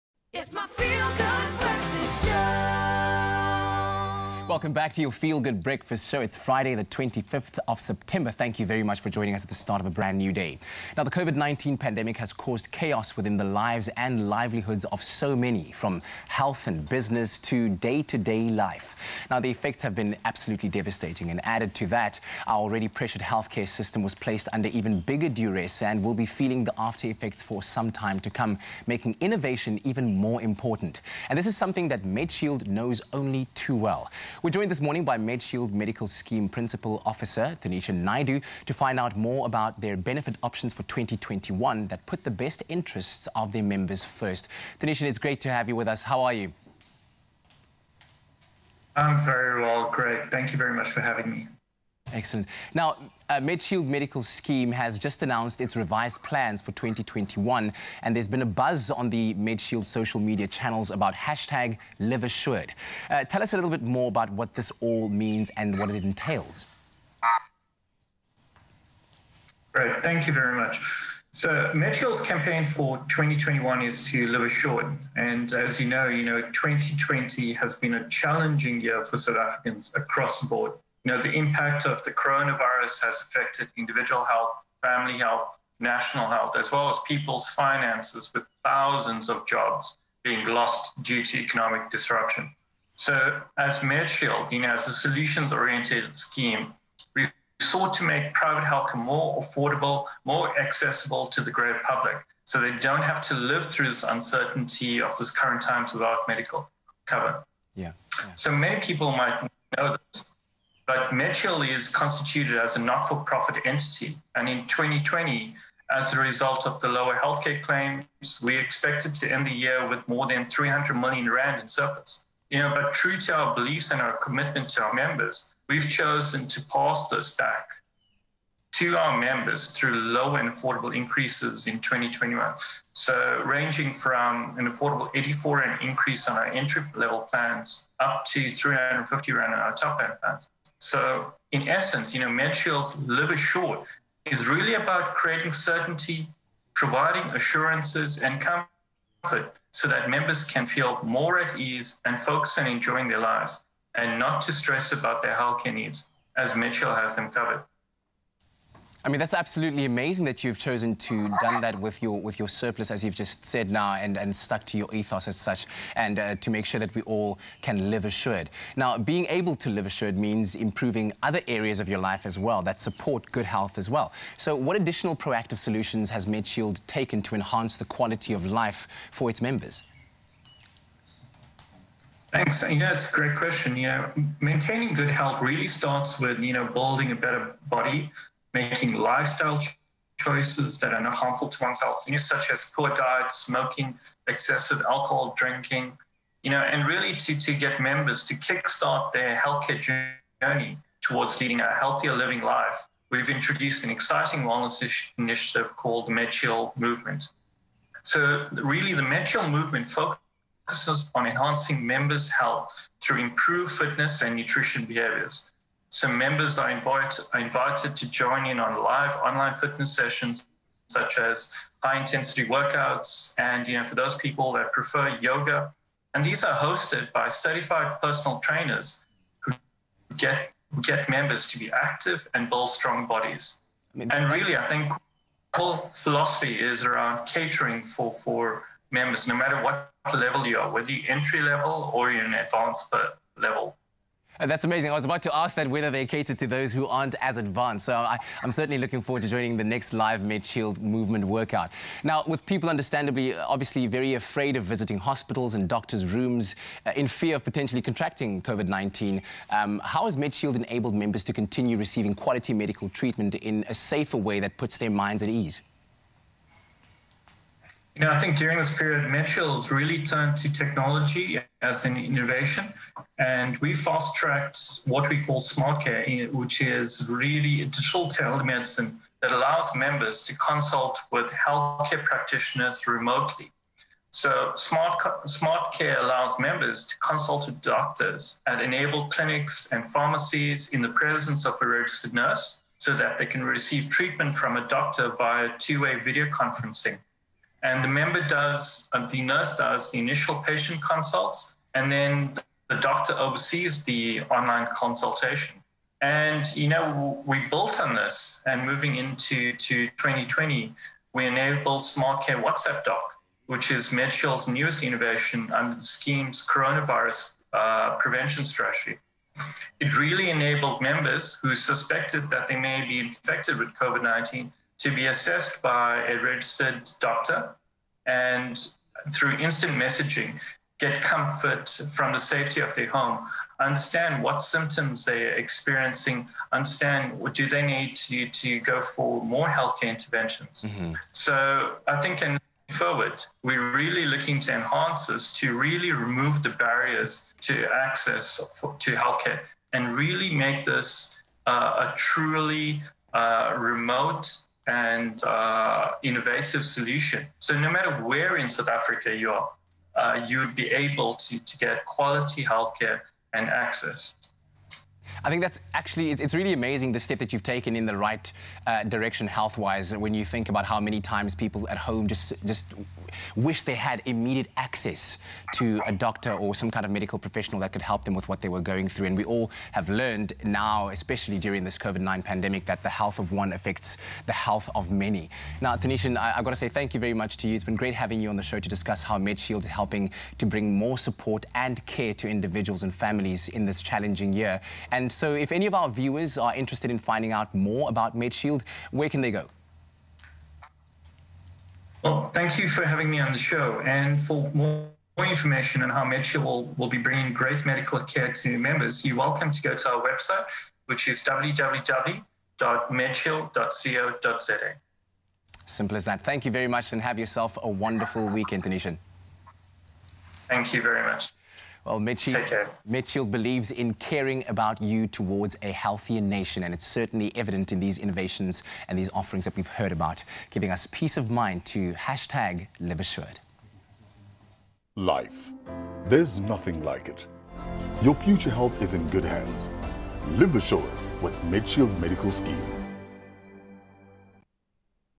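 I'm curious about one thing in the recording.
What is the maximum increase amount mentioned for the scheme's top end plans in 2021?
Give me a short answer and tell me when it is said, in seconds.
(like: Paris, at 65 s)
350 Rand, at 138 s.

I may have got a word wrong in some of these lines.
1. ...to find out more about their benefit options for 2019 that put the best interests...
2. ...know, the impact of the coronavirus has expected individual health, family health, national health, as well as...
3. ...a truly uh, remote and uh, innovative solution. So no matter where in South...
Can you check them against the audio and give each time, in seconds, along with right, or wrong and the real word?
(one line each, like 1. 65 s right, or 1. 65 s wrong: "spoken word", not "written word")
1. 38 s wrong: "2021", not "2019"
2. 81 s wrong: "affected", not "expected"
3. 351 s right.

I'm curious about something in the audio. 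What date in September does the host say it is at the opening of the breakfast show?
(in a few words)
25th of September.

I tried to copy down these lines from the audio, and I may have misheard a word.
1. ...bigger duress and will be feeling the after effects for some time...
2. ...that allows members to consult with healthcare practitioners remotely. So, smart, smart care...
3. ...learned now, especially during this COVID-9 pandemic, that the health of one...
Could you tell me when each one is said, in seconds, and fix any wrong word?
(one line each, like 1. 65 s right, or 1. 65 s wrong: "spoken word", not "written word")
1. 25 s right
2. 279 s right
3. 379 s right.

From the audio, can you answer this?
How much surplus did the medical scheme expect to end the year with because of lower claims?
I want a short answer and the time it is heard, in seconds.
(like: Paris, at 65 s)
more than 300 million Rand, at 120 s.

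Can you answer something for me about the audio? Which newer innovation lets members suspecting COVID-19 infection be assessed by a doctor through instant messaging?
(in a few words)
Smart Care WhatsApp Doc.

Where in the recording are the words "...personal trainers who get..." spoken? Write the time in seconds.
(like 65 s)
228 s.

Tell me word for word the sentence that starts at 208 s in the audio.
So, really, the MedShield Movement focuses on enhancing members' health through improved fitness and nutrition behaviors.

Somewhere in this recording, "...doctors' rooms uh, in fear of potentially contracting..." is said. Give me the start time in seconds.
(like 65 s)
255 s.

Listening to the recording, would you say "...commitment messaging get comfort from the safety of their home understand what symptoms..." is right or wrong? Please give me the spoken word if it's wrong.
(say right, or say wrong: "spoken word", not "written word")
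wrong: "instant", not "commitment".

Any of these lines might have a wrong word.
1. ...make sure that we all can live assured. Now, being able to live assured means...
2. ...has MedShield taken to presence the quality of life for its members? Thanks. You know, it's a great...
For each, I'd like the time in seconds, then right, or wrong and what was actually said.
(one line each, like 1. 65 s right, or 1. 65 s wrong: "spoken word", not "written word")
1. 166 s right
2. 176 s wrong: "enhance", not "presence".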